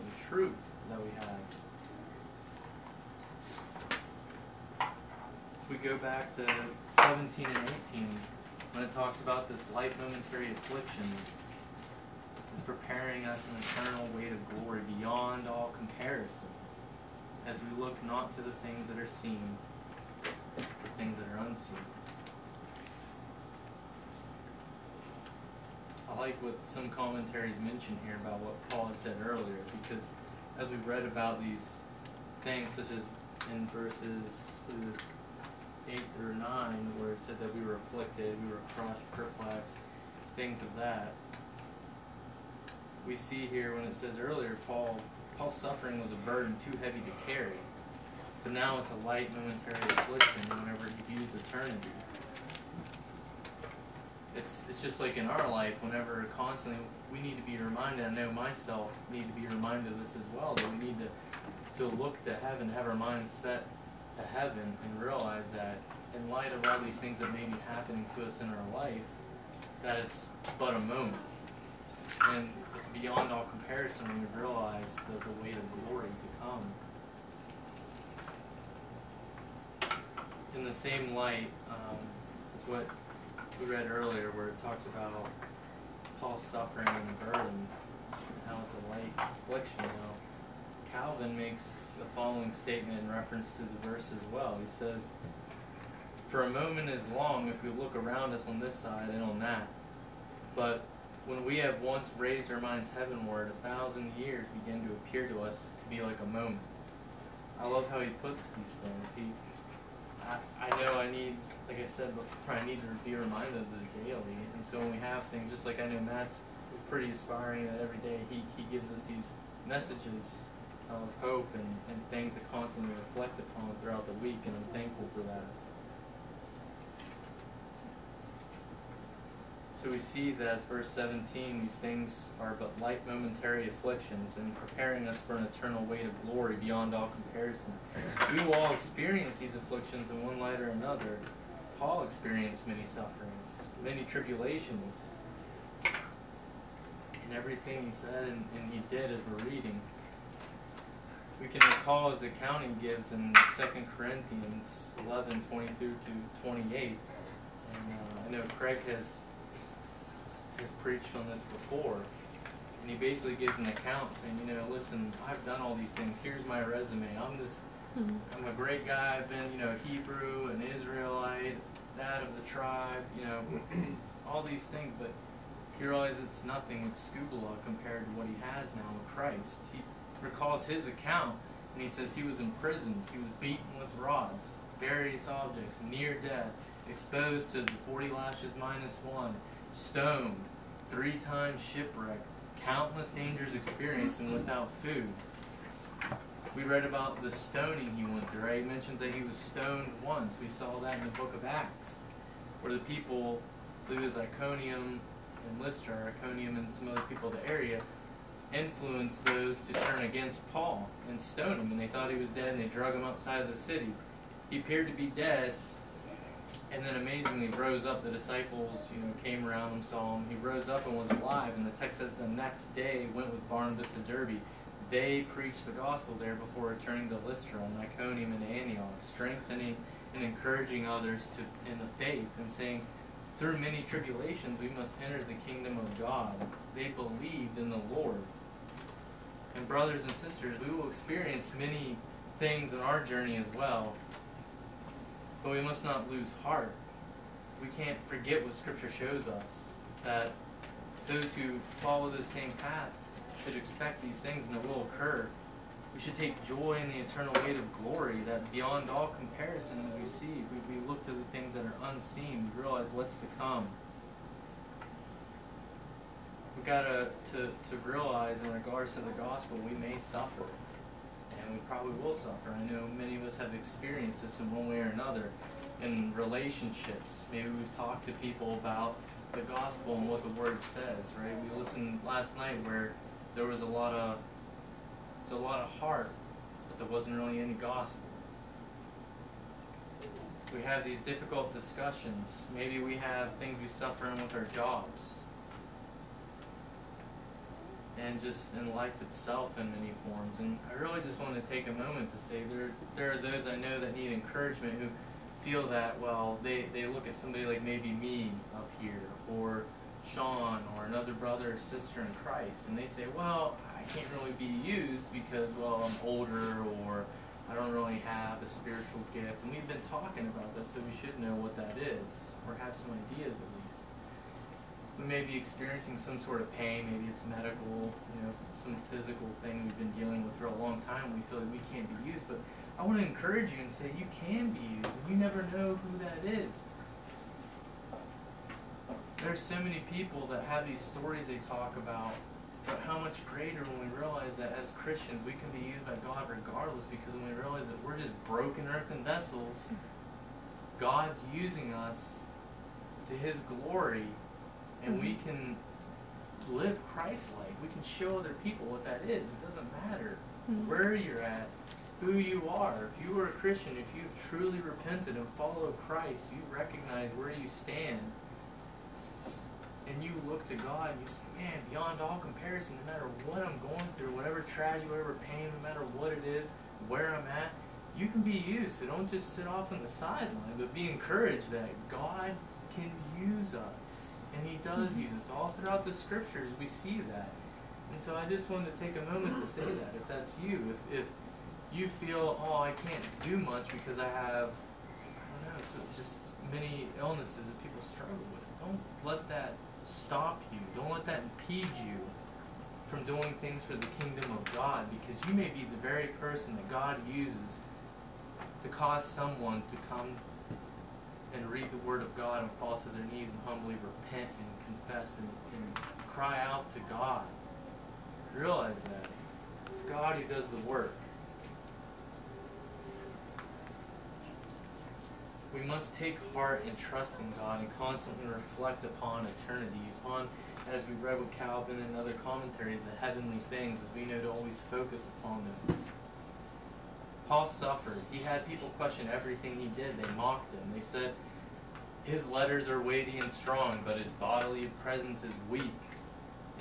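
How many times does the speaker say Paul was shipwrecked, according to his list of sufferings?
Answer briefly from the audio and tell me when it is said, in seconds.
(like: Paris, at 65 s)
3, at 190 s.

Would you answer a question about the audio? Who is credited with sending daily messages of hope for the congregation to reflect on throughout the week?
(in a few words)
Matt.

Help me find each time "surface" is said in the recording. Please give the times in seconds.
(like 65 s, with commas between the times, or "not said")
not said.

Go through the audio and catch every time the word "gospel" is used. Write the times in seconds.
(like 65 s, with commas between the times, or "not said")
225 s, 269 s, 279 s, 287 s.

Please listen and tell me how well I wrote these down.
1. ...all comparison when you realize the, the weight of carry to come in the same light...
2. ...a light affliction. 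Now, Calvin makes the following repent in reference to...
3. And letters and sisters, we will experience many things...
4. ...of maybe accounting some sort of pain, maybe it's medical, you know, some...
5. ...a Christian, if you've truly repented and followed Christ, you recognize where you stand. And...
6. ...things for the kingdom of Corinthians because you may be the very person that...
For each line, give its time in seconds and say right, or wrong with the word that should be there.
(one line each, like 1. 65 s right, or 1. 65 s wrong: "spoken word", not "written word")
1. 73 s wrong: "glory", not "carry"
2. 88 s wrong: "statement", not "repent"
3. 239 s wrong: "brothers", not "letters"
4. 323 s wrong: "experiencing", not "accounting"
5. 363 s right
6. 403 s wrong: "God", not "Corinthians".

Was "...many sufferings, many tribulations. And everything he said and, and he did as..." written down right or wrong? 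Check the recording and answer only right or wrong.
right.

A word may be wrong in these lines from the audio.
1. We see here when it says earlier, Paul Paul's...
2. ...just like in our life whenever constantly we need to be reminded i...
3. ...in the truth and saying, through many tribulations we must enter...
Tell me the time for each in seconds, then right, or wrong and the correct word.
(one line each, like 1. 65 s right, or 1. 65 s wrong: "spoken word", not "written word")
1. 43 s right
2. 54 s right
3. 231 s wrong: "faith", not "truth".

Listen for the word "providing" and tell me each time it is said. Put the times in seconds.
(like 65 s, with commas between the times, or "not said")
not said.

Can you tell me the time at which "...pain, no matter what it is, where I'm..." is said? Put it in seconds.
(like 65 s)
375 s.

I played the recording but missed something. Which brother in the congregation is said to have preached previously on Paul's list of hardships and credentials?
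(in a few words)
Craig.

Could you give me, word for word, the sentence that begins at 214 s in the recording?
He appeared to be dead, and then amazingly rose up.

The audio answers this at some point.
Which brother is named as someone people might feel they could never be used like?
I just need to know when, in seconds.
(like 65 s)
310 s.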